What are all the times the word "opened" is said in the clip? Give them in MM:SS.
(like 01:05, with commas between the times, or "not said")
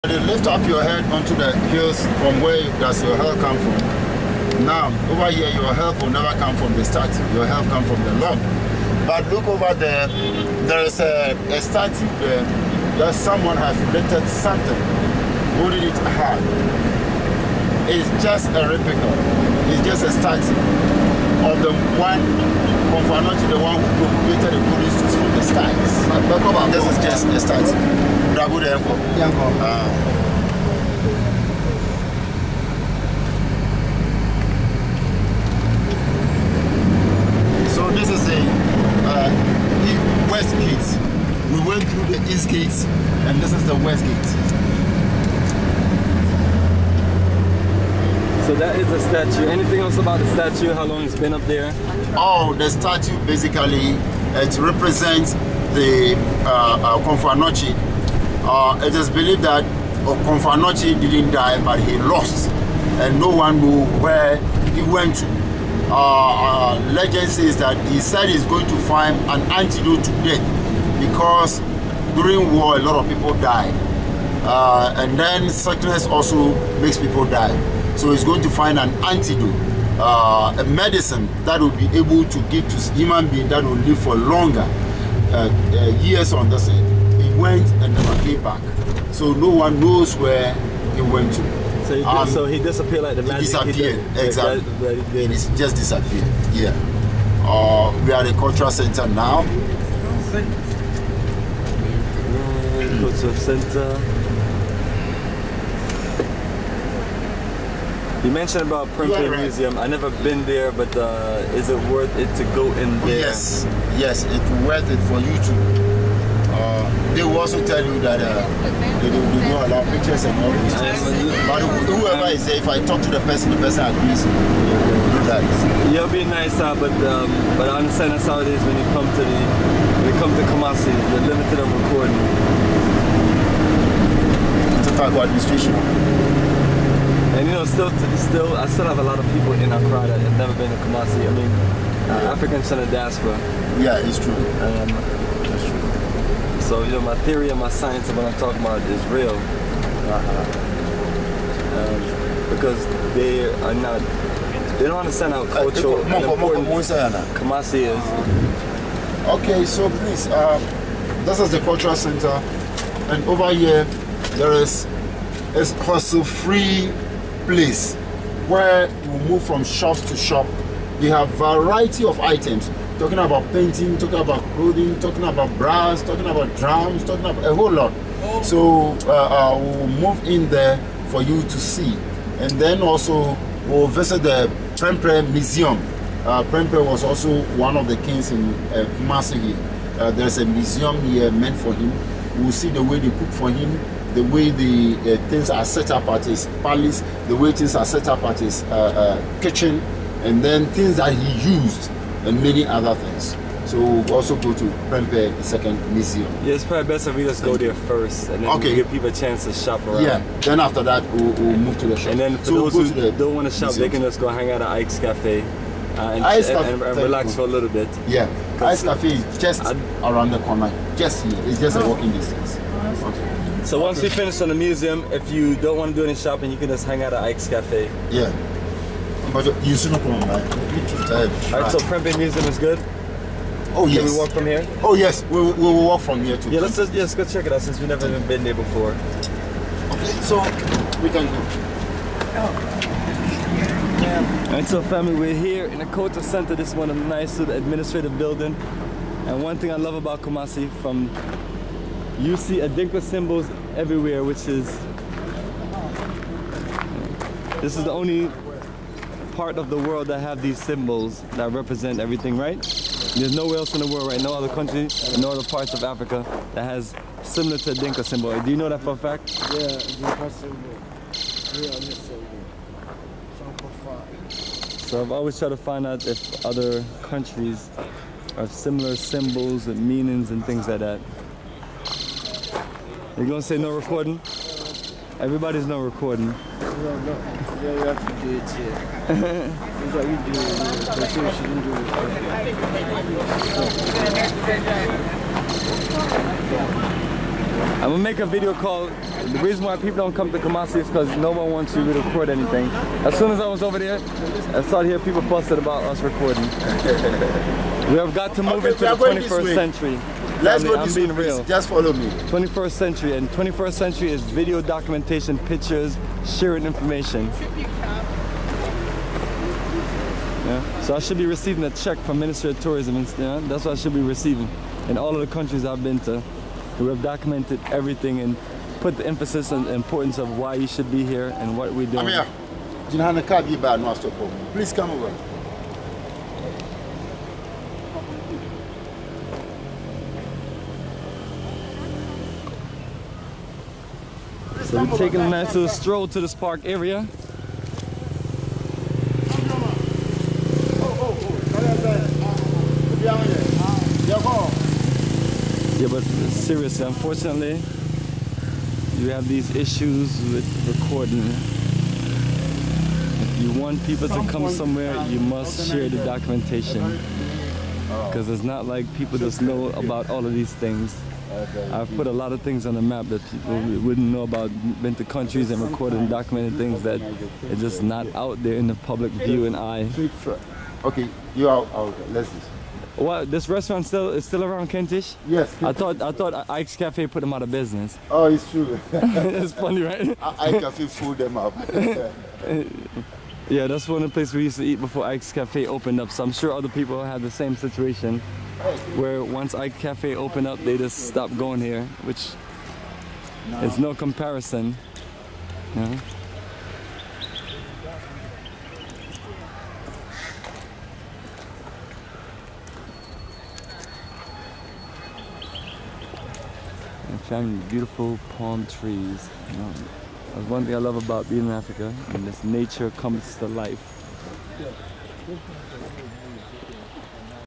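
06:35, 06:40.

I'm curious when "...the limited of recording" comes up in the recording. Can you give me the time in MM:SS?
02:10.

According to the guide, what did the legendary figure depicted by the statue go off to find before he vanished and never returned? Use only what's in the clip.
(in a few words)
An antidote to death.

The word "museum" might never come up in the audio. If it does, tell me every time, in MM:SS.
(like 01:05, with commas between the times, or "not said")
01:49, 03:05, 03:10, 03:25, 03:33, 03:44, 03:52.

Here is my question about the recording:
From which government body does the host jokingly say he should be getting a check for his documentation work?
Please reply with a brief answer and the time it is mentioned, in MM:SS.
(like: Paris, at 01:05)
Ministry of Tourism, at 05:22.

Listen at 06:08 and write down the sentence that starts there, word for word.
Because it's not like people just know about all of these things.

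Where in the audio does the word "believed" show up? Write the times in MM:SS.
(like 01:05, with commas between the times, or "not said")
00:59.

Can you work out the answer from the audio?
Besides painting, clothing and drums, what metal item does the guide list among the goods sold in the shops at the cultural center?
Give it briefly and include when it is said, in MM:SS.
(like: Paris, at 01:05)
Brass, at 02:55.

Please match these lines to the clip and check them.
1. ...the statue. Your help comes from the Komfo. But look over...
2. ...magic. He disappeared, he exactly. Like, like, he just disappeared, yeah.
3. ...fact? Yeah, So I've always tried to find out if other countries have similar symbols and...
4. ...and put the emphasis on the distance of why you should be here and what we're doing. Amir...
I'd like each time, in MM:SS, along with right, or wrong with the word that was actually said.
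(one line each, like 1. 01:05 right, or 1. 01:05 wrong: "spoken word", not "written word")
1. 00:06 wrong: "Lord", not "Komfo"
2. 01:33 right
3. 04:28 right
4. 05:28 wrong: "importance", not "distance".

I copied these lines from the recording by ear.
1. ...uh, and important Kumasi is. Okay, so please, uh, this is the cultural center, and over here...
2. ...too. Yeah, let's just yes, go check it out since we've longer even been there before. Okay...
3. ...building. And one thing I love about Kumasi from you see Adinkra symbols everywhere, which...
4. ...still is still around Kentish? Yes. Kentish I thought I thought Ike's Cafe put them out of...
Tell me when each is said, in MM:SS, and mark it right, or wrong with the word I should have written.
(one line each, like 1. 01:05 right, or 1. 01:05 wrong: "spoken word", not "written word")
1. 02:35 right
2. 03:56 wrong: "never", not "longer"
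3. 04:08 right
4. 06:23 right.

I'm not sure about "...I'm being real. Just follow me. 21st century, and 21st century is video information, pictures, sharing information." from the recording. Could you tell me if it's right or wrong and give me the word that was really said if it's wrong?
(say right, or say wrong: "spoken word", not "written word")
wrong: "documentation", not "information".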